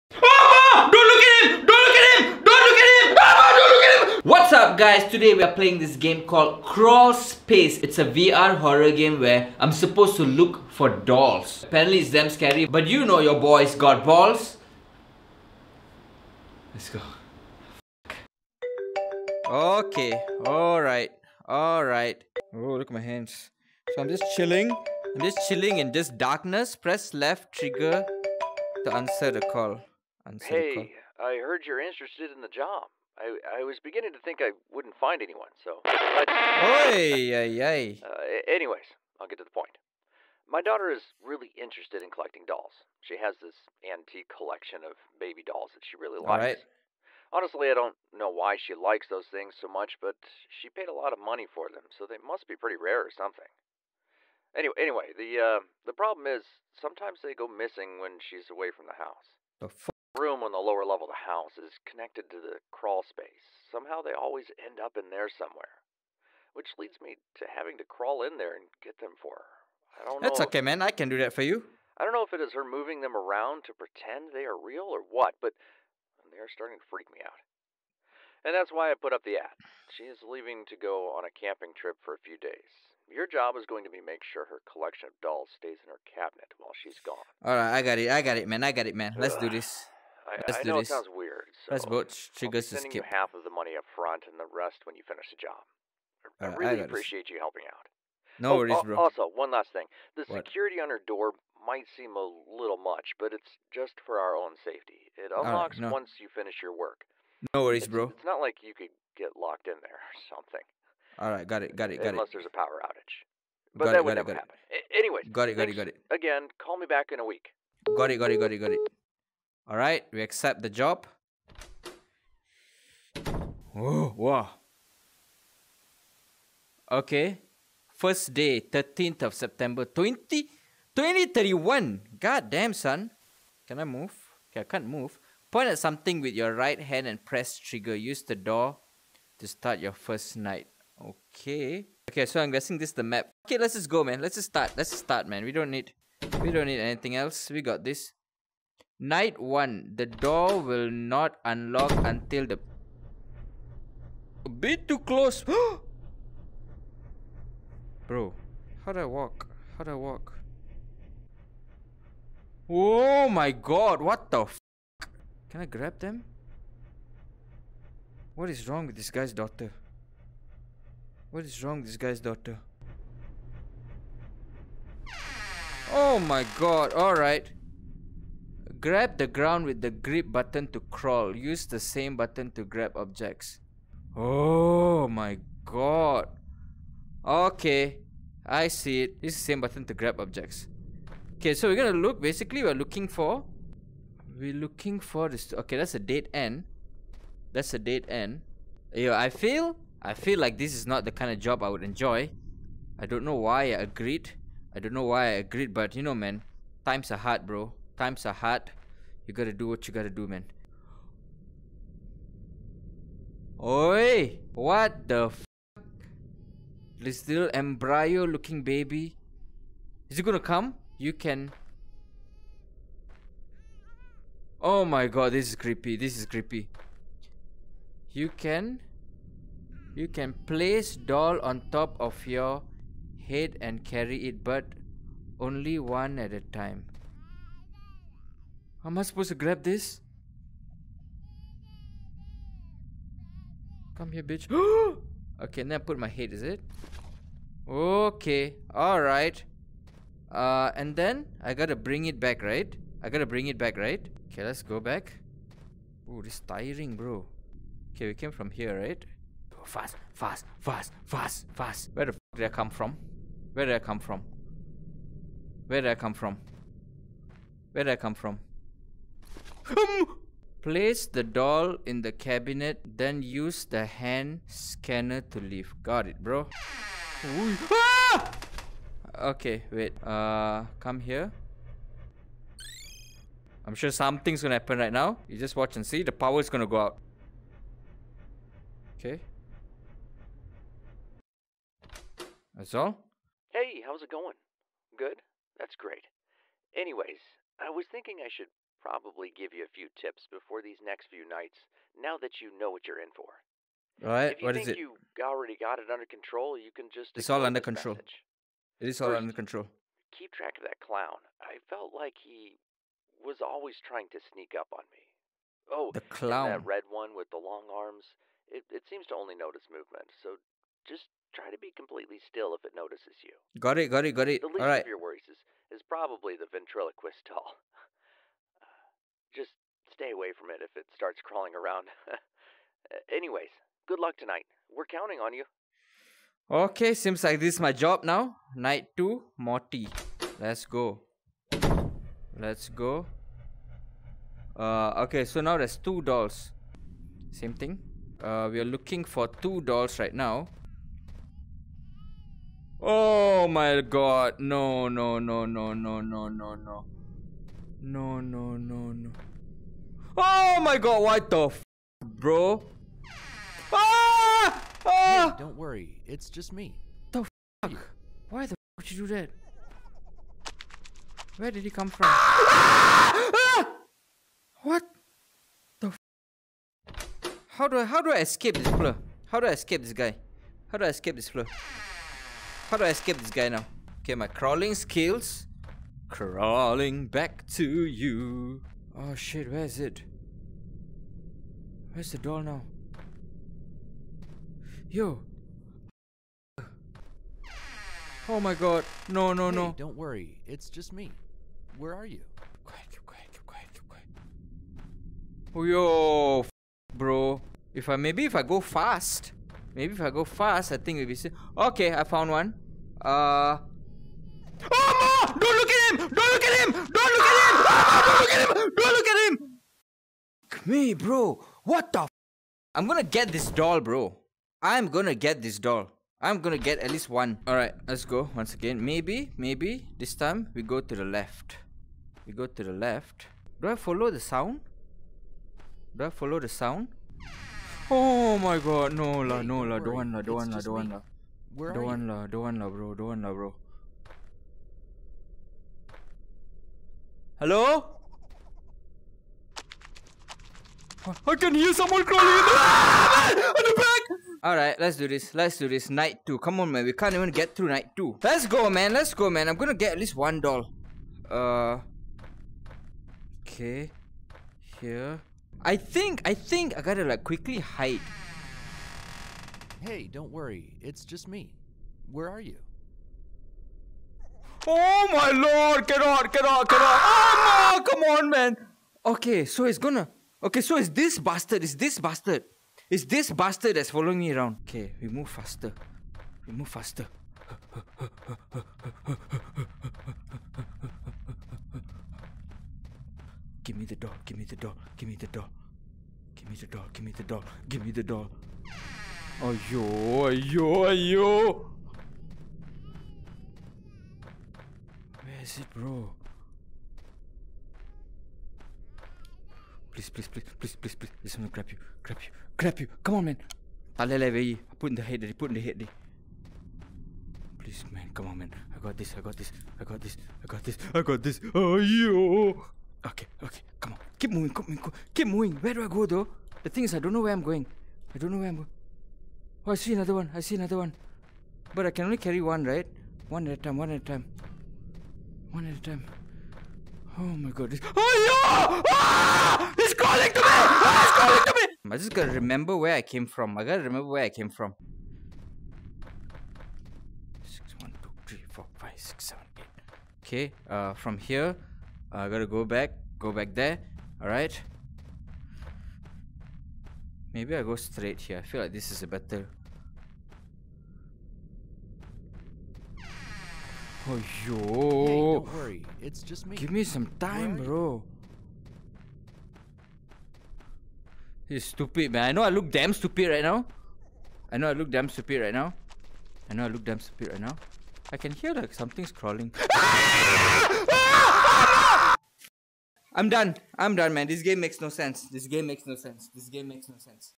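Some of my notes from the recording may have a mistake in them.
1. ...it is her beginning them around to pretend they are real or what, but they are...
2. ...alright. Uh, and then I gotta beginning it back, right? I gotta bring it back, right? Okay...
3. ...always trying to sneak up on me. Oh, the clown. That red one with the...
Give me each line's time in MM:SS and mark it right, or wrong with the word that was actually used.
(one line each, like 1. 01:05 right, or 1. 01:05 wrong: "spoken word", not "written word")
1. 01:12 wrong: "moving", not "beginning"
2. 04:08 wrong: "bring", not "beginning"
3. 05:13 right.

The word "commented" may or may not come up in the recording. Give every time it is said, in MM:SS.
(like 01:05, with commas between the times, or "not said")
not said.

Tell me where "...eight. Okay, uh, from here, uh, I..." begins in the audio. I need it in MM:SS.
09:09.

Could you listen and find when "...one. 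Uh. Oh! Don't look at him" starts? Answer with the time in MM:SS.
06:52.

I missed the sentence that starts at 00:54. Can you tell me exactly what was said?
Anyway, anyway, the uh, the problem is sometimes they go missing when she's away from the house.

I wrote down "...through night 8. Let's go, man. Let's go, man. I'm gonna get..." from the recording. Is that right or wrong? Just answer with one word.
wrong.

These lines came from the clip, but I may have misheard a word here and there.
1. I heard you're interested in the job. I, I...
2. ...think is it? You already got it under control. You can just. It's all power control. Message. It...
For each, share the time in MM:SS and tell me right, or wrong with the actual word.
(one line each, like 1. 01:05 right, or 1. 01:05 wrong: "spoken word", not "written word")
1. 00:31 right
2. 05:04 wrong: "under", not "power".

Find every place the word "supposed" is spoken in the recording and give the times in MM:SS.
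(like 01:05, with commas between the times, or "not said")
00:09, 03:59.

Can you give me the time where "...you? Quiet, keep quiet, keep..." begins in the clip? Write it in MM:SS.
06:42.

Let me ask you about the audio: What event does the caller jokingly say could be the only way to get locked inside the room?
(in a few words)
power outage.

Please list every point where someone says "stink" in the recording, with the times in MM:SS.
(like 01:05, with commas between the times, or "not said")
not said.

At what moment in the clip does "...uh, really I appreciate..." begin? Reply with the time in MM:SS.
01:36.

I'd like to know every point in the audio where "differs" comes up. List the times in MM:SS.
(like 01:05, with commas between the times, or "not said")
not said.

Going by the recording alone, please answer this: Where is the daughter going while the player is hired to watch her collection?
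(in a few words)
camping trip.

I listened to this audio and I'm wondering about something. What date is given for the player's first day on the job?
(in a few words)
13th of September.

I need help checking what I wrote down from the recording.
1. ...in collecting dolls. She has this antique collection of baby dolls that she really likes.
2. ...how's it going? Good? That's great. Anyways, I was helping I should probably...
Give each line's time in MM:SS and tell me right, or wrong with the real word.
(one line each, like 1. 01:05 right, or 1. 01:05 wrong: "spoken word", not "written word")
1. 00:42 right
2. 04:53 wrong: "thinking", not "helping".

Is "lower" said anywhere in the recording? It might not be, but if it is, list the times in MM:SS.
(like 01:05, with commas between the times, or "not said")
01:00.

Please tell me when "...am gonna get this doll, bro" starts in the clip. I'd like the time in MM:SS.
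07:02.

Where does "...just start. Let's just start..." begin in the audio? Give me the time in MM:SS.
02:24.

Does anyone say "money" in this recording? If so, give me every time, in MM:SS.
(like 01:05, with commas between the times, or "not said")
00:51, 01:33.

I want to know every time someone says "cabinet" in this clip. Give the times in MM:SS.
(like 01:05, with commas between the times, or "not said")
01:26, 04:32.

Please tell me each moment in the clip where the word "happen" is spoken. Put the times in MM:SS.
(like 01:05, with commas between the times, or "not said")
01:54, 04:44.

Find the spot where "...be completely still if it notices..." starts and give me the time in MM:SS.
05:21.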